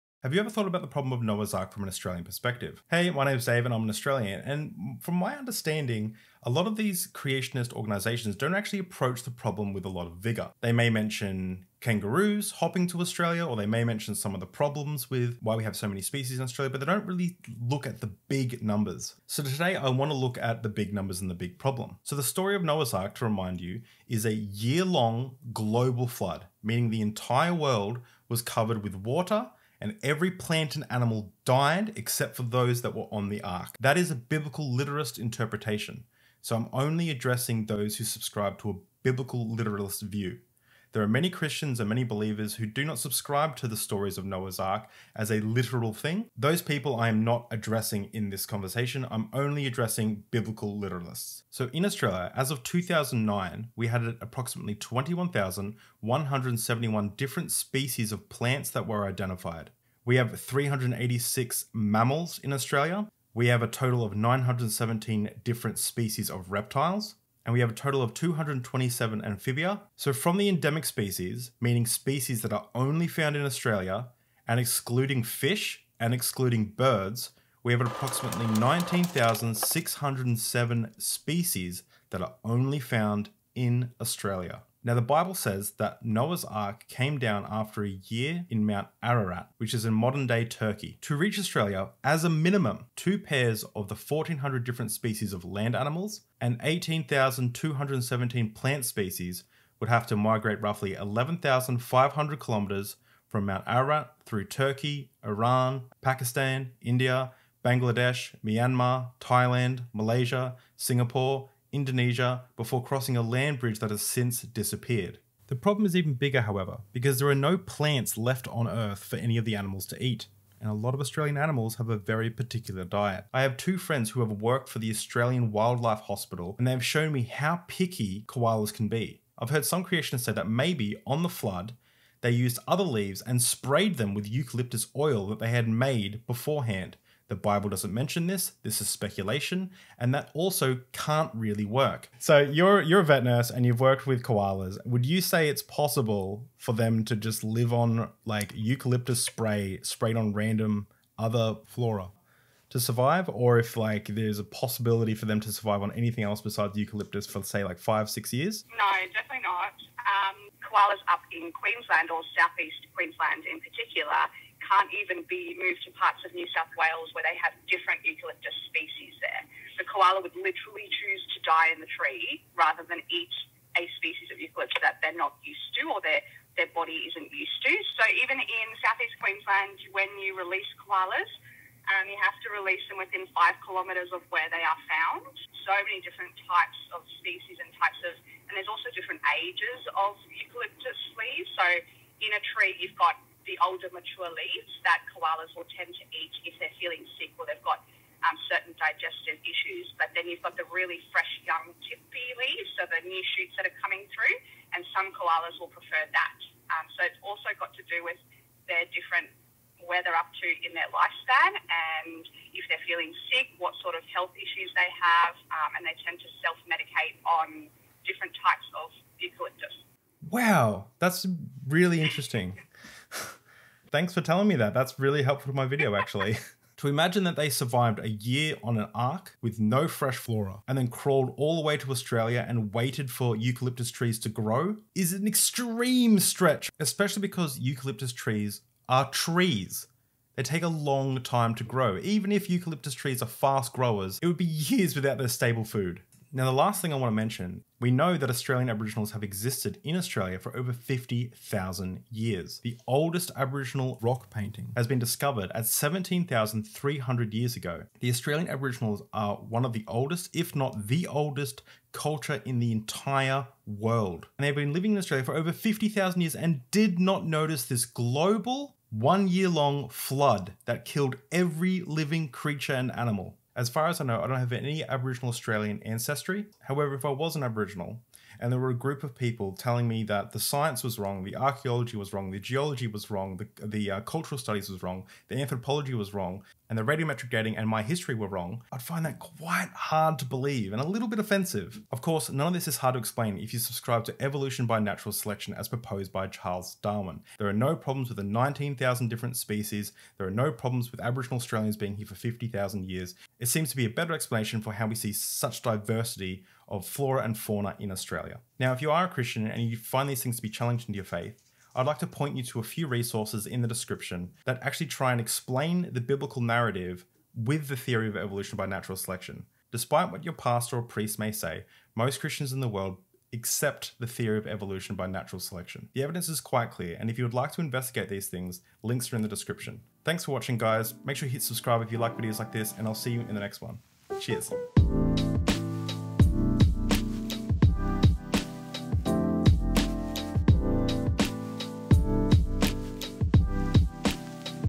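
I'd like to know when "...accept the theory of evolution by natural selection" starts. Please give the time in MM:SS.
05:23.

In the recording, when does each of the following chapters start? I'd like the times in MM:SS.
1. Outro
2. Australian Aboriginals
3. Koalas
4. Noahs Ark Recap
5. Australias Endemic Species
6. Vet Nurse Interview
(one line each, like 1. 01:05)
1. 04:52
2. 04:06
3. 02:00
4. 00:23
5. 00:51
6. 02:38.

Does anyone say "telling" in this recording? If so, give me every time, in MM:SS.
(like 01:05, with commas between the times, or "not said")
03:44, 04:39.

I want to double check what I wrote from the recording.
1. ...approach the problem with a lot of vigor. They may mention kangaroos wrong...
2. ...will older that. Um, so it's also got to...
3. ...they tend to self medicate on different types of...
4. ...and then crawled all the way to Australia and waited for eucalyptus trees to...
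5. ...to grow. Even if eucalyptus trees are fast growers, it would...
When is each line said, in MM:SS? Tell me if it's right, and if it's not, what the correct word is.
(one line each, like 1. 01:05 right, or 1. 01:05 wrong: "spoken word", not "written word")
1. 00:08 wrong: "hopping", not "wrong"
2. 03:25 wrong: "prefer", not "older"
3. 03:35 right
4. 03:50 right
5. 04:01 right.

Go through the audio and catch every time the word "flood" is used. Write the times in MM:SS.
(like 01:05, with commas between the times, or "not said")
00:26, 02:11, 04:29.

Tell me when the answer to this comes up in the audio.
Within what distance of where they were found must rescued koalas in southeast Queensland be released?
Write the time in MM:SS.
03:03.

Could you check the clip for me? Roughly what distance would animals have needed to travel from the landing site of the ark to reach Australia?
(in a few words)
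11,500 kilometres.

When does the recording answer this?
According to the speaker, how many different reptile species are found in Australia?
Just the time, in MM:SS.
01:04.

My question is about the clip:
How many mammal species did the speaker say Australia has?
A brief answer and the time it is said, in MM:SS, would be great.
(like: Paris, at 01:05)
386, at 01:00.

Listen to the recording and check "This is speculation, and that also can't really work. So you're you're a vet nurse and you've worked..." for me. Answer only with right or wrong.
right.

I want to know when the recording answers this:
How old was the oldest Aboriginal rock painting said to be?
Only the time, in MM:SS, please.
04:15.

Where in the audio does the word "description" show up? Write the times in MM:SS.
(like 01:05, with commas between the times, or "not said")
05:13, 05:29.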